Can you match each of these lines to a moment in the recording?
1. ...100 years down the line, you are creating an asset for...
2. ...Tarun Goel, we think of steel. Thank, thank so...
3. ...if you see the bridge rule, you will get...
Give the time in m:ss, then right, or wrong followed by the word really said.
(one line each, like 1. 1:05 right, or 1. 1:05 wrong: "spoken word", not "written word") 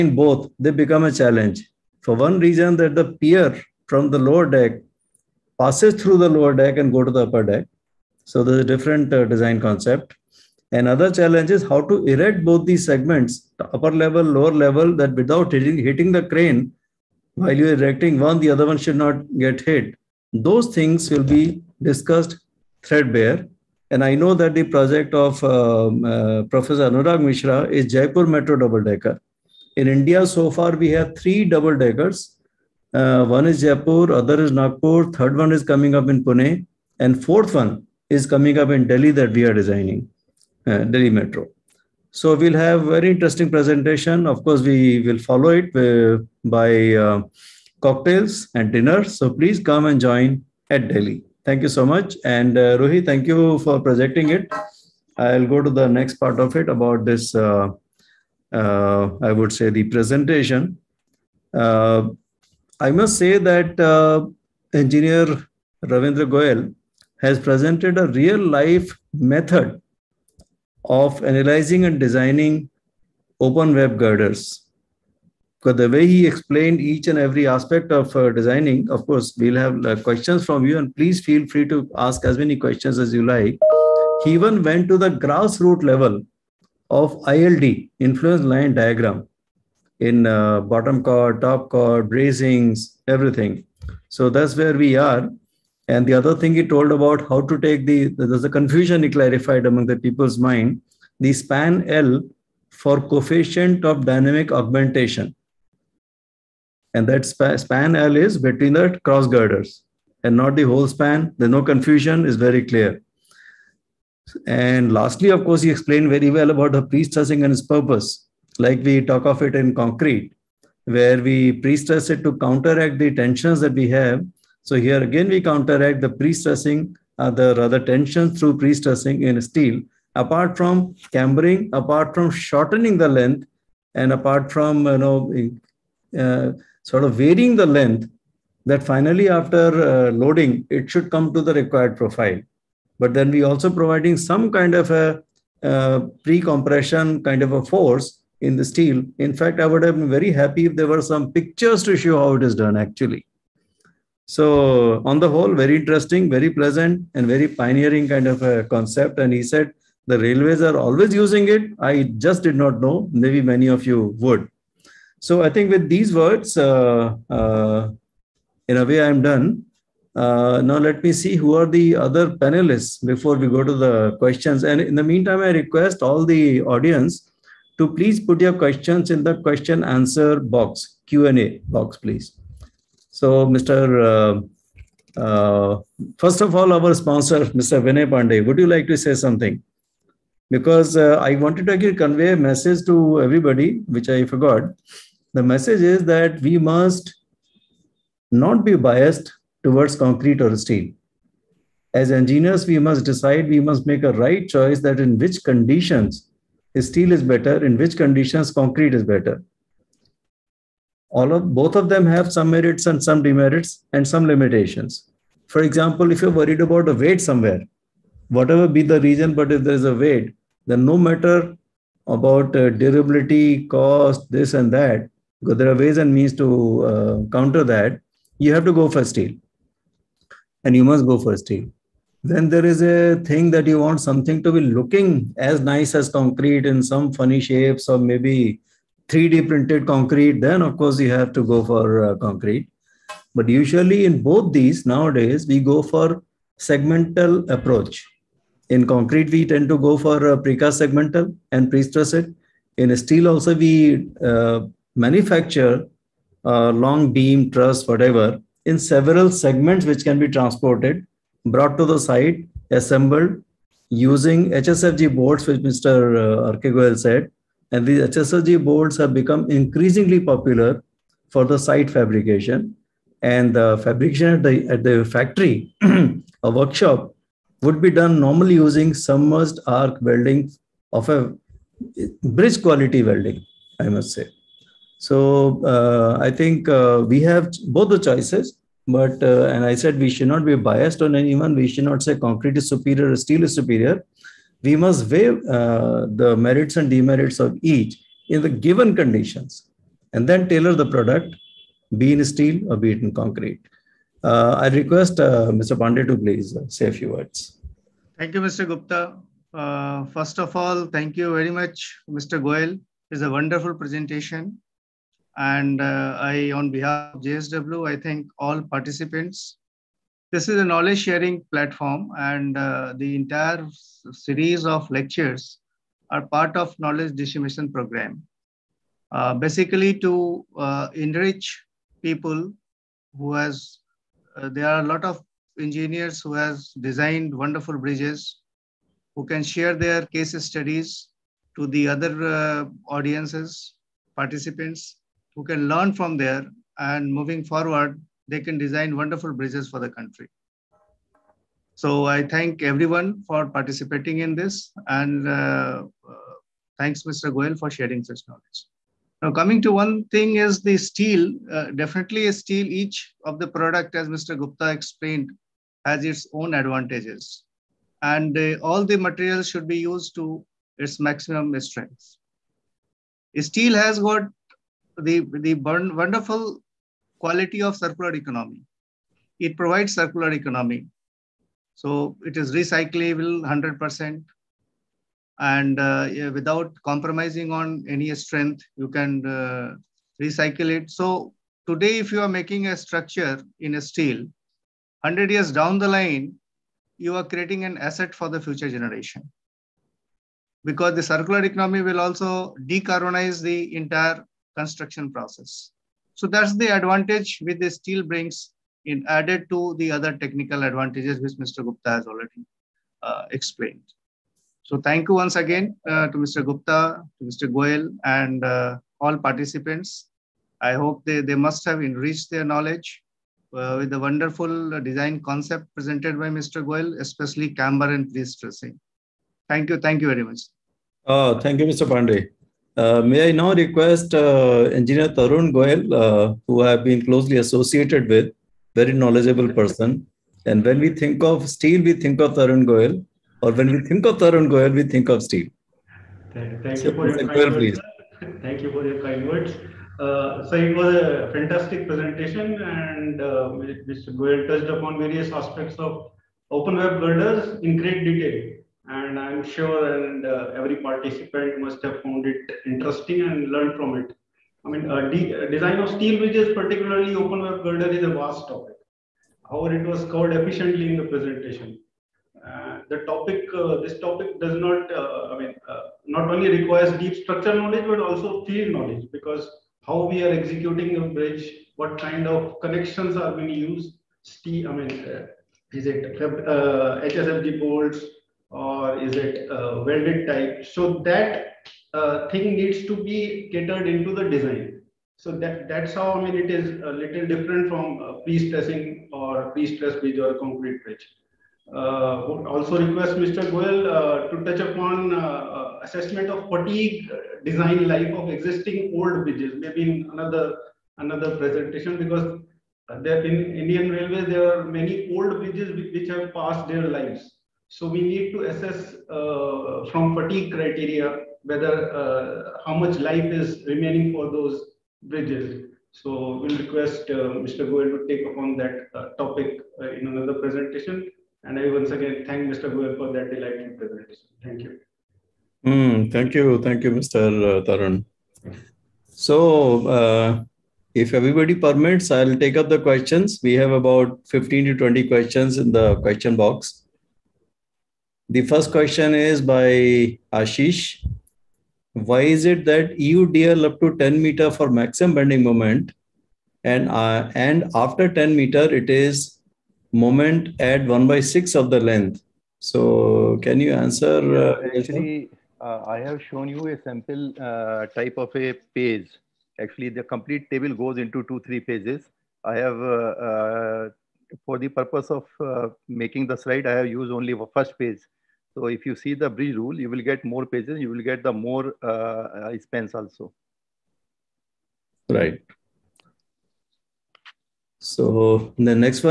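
1. 6:35 right
2. 7:24 right
3. 9:38 right.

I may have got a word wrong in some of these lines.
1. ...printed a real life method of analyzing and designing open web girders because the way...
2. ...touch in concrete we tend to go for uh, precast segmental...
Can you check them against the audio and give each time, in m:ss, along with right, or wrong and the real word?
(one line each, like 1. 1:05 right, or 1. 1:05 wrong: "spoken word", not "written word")
1. 1:07 wrong: "presented", not "printed"
2. 4:07 wrong: "approach", not "touch".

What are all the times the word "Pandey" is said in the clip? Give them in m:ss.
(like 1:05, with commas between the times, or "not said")
3:08, 5:05, 7:11.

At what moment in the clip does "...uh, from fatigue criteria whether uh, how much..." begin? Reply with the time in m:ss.
8:39.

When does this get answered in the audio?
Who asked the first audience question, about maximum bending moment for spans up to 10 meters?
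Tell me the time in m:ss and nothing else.
9:10.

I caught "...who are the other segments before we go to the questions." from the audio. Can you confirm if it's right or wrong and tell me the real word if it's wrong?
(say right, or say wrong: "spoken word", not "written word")
wrong: "panelists", not "segments".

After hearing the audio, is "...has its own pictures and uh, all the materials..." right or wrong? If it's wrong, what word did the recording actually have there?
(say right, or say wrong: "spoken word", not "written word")
wrong: "advantages", not "pictures".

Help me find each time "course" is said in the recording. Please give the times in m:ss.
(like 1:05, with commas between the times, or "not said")
0:44, 1:19, 1:55, 4:00.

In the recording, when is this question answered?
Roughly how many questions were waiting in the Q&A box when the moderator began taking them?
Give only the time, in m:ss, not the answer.
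9:04.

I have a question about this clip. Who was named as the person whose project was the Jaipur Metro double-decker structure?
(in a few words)
Anurag Mishra.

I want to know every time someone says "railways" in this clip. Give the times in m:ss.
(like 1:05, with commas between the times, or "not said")
2:40, 8:33.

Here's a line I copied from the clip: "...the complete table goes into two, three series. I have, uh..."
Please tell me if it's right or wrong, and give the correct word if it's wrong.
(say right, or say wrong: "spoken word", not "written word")
wrong: "pages", not "series".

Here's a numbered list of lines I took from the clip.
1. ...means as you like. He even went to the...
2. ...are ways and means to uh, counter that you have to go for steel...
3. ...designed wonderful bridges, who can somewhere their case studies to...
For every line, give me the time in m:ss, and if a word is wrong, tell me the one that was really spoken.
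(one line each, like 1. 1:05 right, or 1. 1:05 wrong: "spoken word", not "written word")
1. 1:22 wrong: "questions", not "means"
2. 3:45 right
3. 5:36 wrong: "share", not "somewhere".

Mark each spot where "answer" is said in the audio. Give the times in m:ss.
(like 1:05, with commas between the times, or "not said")
2:59, 9:23.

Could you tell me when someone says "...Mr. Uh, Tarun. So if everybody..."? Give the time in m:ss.
8:56.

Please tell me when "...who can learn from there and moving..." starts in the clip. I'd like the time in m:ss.
5:45.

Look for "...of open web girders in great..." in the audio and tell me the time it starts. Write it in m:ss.
7:35.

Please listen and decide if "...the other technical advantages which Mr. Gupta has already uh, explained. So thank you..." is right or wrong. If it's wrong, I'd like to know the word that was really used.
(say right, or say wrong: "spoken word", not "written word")
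right.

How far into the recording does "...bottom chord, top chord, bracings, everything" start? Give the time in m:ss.
1:30.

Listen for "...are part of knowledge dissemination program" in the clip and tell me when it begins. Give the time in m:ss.
5:26.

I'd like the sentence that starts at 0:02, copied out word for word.
For one reason that the pier from the lower deck passes through the lower deck and go to the upper deck.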